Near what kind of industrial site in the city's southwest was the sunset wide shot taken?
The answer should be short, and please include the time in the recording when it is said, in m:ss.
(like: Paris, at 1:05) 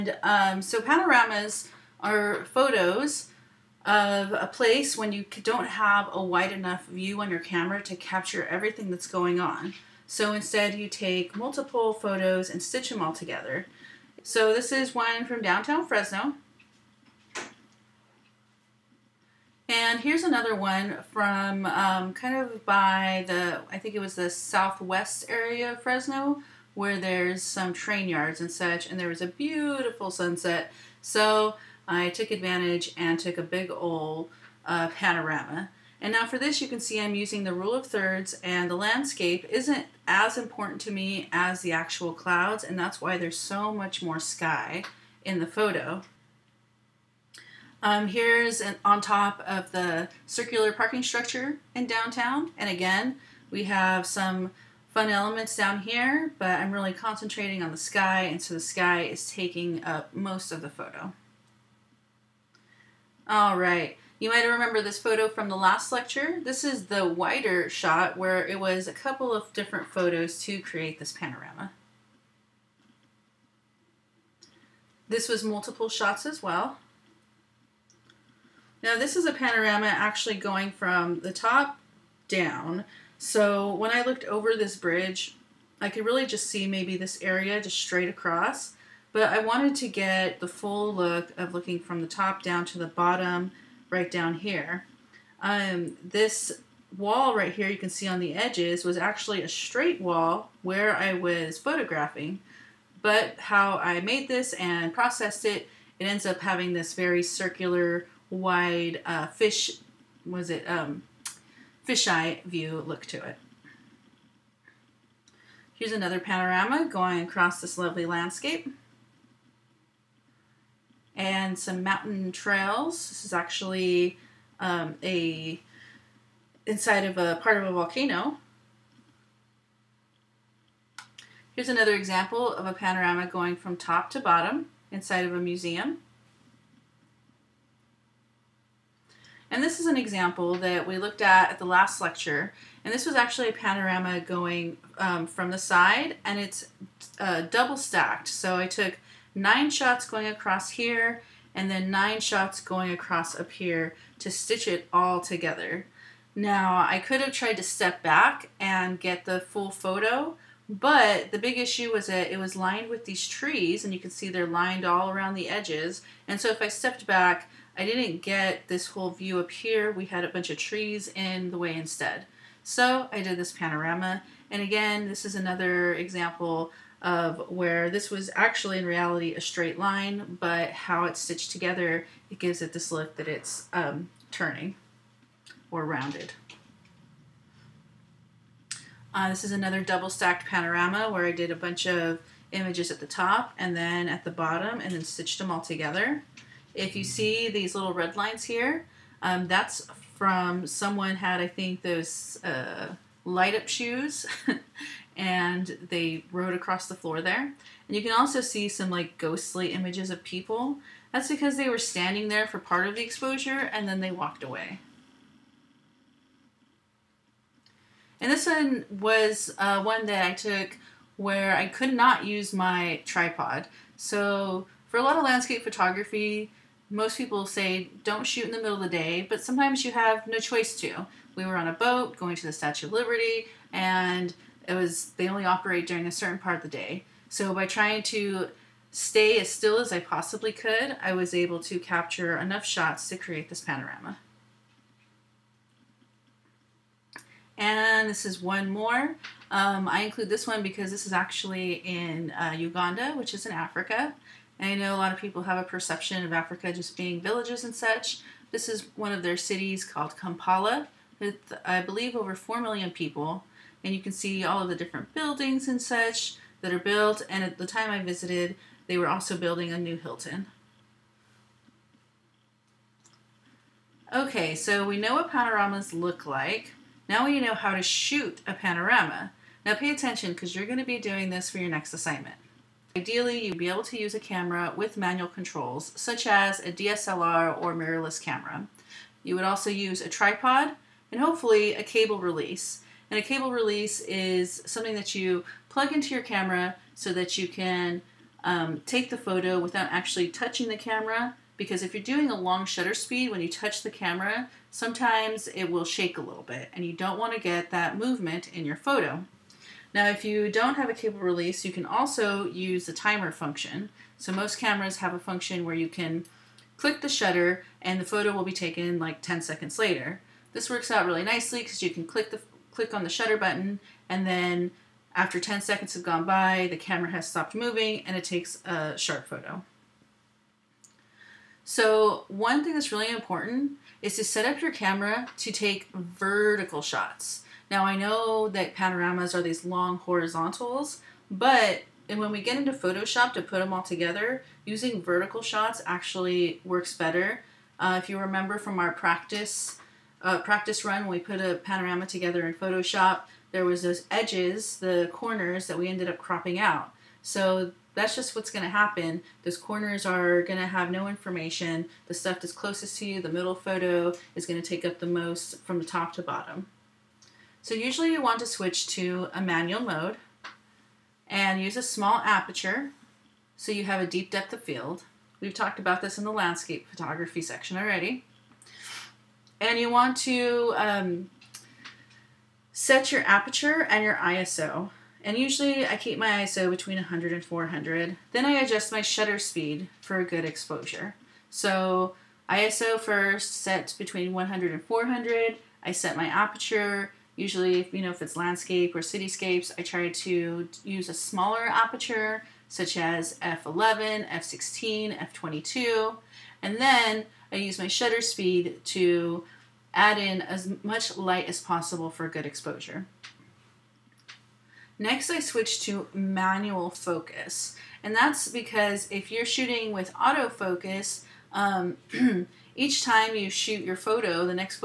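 Train yards, at 0:27.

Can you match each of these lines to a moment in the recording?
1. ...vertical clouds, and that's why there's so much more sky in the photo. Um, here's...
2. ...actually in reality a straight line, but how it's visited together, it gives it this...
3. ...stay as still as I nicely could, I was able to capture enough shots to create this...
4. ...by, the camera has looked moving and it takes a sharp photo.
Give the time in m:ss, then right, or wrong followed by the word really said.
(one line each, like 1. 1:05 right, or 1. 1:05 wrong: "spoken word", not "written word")
1. 0:41 wrong: "actual", not "vertical"
2. 2:58 wrong: "stitched", not "visited"
3. 3:58 wrong: "possibly", not "nicely"
4. 5:26 wrong: "stopped", not "looked".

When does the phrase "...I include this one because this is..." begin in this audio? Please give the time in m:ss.
4:09.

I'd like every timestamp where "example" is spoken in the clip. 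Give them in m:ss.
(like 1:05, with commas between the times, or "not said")
2:11, 2:19, 2:55.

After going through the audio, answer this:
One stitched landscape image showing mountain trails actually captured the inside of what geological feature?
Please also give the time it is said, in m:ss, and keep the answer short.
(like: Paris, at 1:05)
A volcano, at 2:07.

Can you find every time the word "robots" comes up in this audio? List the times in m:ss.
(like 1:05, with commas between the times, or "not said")
not said.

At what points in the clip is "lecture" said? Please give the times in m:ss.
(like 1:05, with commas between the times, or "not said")
1:05, 2:21.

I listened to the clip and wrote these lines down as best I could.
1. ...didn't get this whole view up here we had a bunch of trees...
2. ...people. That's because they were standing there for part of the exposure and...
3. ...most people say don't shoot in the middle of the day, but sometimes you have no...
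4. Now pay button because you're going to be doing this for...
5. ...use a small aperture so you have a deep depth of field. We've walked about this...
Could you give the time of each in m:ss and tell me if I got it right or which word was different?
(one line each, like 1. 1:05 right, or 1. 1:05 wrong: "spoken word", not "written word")
1. 2:47 right
2. 3:30 right
3. 3:46 right
4. 4:39 wrong: "attention", not "button"
5. 6:11 wrong: "talked", not "walked".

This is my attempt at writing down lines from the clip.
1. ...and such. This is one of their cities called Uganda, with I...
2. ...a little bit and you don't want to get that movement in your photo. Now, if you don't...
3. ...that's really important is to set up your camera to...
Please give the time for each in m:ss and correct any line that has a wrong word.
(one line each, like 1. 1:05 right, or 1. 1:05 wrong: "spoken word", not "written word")
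1. 4:17 wrong: "Kampala", not "Uganda"
2. 5:06 right
3. 5:32 right.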